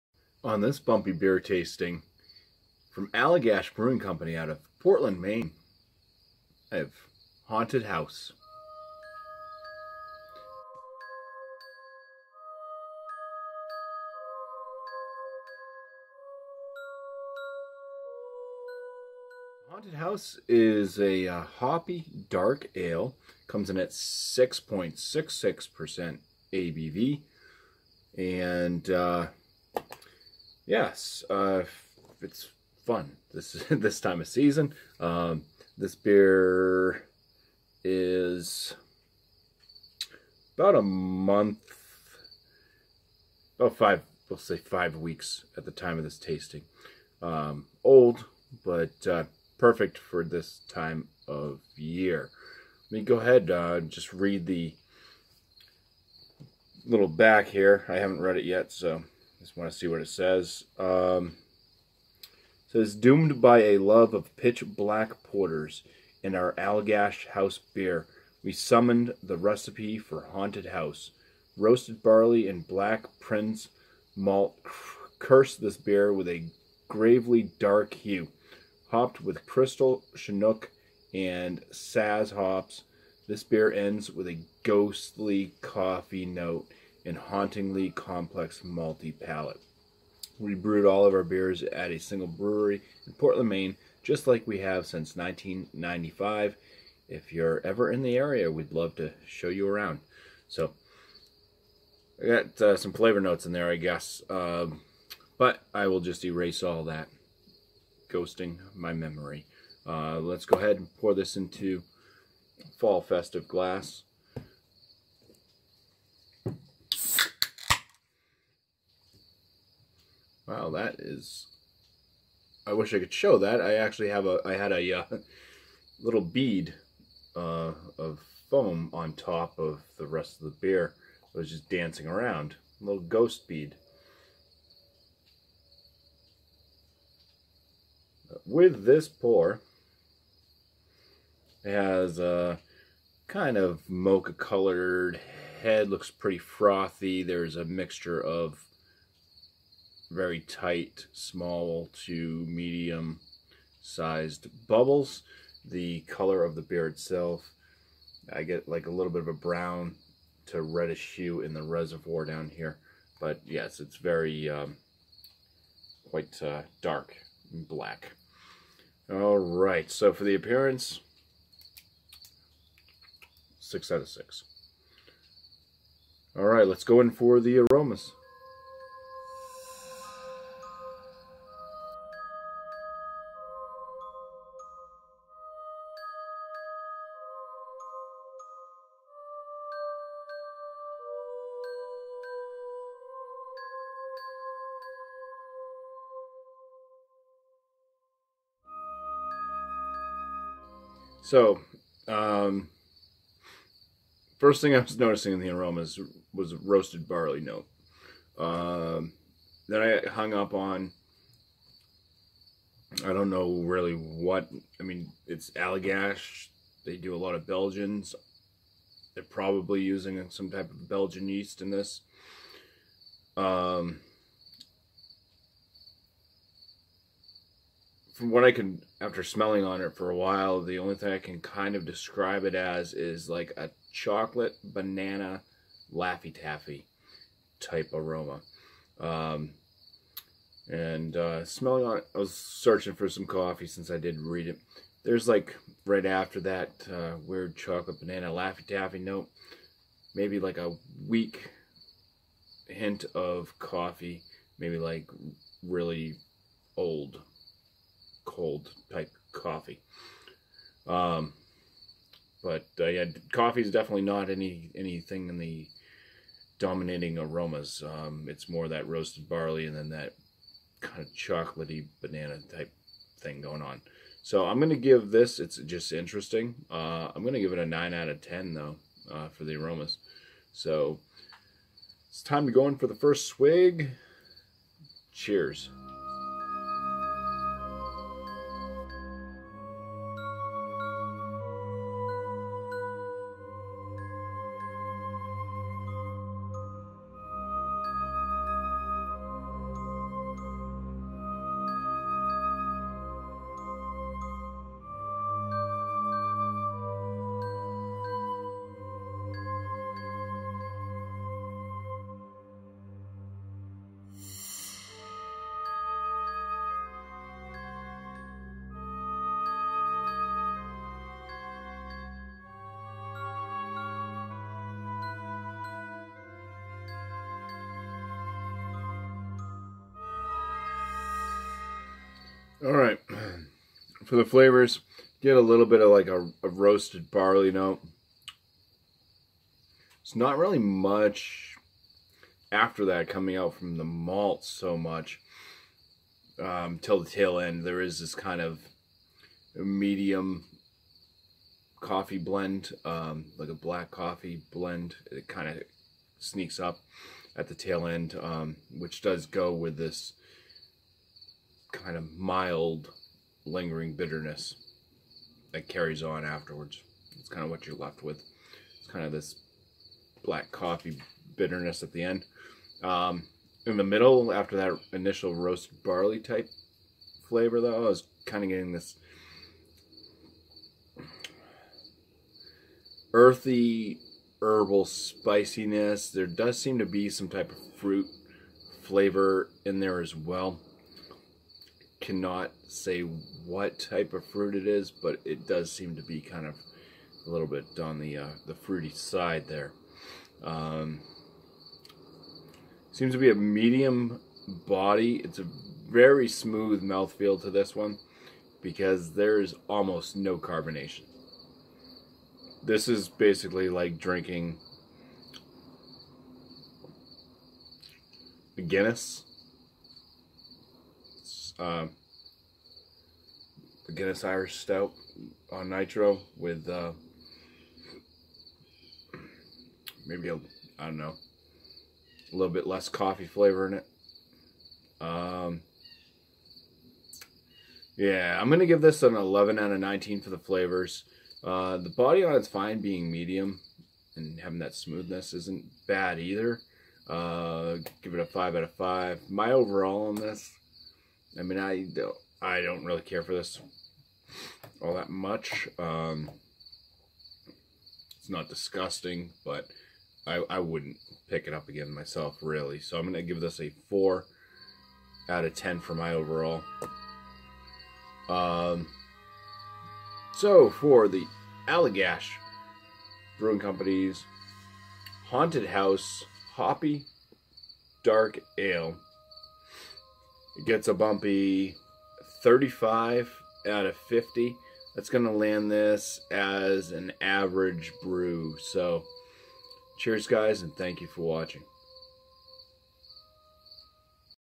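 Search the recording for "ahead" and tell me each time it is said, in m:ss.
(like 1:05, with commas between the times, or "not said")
0:53, 1:50.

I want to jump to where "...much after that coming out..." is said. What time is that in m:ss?
5:40.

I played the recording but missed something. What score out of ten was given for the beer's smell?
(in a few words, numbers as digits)
9.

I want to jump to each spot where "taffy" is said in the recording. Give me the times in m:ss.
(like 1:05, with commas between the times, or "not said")
3:56, 4:08.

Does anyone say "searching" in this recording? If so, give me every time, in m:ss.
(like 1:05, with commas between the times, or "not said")
4:02.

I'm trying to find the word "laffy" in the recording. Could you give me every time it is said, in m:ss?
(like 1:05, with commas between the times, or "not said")
3:55, 4:08.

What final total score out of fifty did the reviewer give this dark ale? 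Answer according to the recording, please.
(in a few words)
35.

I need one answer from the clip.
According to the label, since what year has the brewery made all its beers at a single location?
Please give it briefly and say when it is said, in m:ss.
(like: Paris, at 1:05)
1995, at 1:35.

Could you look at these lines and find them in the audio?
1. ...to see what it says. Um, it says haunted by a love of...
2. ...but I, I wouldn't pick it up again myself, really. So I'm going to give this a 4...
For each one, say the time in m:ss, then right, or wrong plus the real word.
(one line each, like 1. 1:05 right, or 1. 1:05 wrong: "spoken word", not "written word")
1. 0:59 wrong: "doomed", not "haunted"
2. 7:39 right.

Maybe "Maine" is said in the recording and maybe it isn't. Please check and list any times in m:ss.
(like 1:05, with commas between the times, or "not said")
0:05, 1:33.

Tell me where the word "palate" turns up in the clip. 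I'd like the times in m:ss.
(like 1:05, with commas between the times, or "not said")
1:29.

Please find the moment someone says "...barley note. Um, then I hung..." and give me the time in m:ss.
3:27.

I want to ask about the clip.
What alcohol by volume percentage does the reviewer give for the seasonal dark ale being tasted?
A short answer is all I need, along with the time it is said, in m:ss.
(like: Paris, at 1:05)
6.66%, at 0:23.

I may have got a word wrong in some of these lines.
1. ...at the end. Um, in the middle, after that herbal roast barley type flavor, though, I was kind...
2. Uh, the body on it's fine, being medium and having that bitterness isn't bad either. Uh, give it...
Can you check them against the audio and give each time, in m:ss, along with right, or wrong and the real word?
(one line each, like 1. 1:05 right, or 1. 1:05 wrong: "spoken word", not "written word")
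1. 6:11 wrong: "initial", not "herbal"
2. 7:21 wrong: "smoothness", not "bitterness".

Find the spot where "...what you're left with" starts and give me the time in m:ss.
6:07.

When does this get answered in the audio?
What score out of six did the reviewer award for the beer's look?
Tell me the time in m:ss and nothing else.
2:53.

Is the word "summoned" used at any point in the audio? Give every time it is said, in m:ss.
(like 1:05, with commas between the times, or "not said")
1:08.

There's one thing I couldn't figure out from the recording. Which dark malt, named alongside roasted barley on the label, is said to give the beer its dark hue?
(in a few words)
black prince malt.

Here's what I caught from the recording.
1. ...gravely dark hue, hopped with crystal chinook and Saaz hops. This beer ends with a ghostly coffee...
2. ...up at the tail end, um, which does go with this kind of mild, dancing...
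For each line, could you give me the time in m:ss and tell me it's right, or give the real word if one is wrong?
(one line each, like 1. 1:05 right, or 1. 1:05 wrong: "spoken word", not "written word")
1. 1:16 right
2. 5:56 wrong: "lingering", not "dancing".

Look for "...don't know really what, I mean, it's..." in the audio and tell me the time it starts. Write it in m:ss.
3:33.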